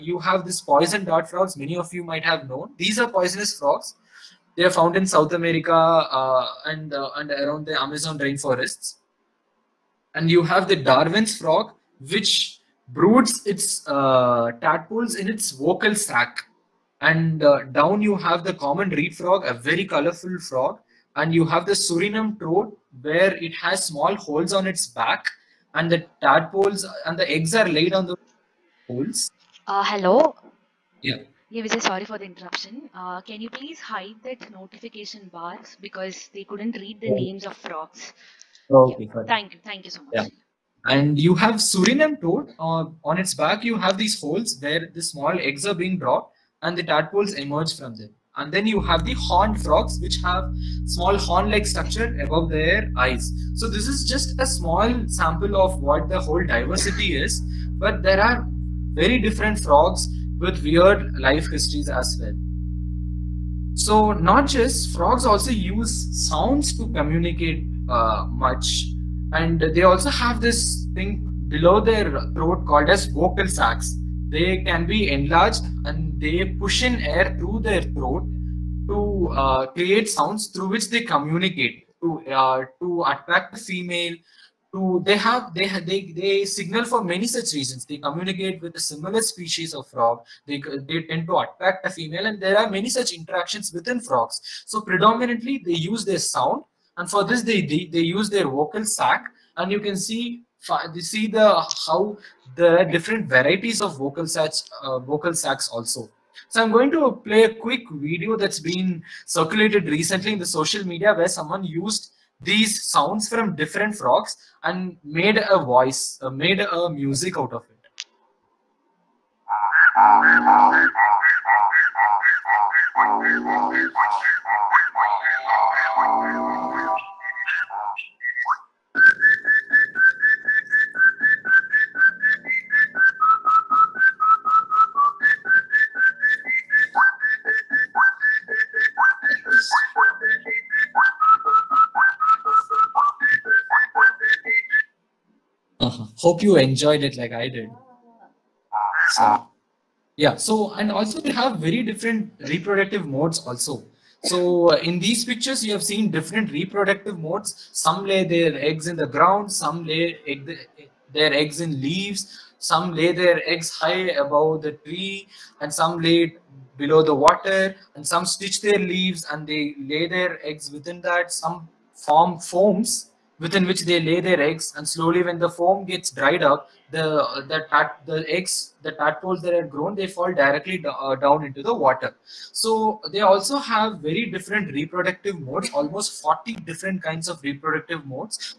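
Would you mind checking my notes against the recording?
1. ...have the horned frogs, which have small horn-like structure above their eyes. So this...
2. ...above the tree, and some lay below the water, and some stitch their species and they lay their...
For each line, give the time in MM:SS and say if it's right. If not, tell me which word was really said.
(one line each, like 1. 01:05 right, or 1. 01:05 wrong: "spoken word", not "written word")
1. 00:48 right
2. 02:44 wrong: "leaves", not "species".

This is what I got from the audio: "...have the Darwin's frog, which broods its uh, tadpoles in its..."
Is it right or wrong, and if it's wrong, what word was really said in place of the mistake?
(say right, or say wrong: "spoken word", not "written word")
right.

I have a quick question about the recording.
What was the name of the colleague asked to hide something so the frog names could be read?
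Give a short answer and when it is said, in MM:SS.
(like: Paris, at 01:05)
Vijay, at 00:31.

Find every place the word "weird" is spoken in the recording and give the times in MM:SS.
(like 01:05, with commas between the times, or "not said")
01:00.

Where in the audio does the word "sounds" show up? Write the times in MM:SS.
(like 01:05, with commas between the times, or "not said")
01:06, 01:20, 01:36, 01:52.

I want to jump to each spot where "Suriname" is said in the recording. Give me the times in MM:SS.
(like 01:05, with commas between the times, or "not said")
00:21, 00:41.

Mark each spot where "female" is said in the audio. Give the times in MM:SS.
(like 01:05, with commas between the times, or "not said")
01:23, 01:31.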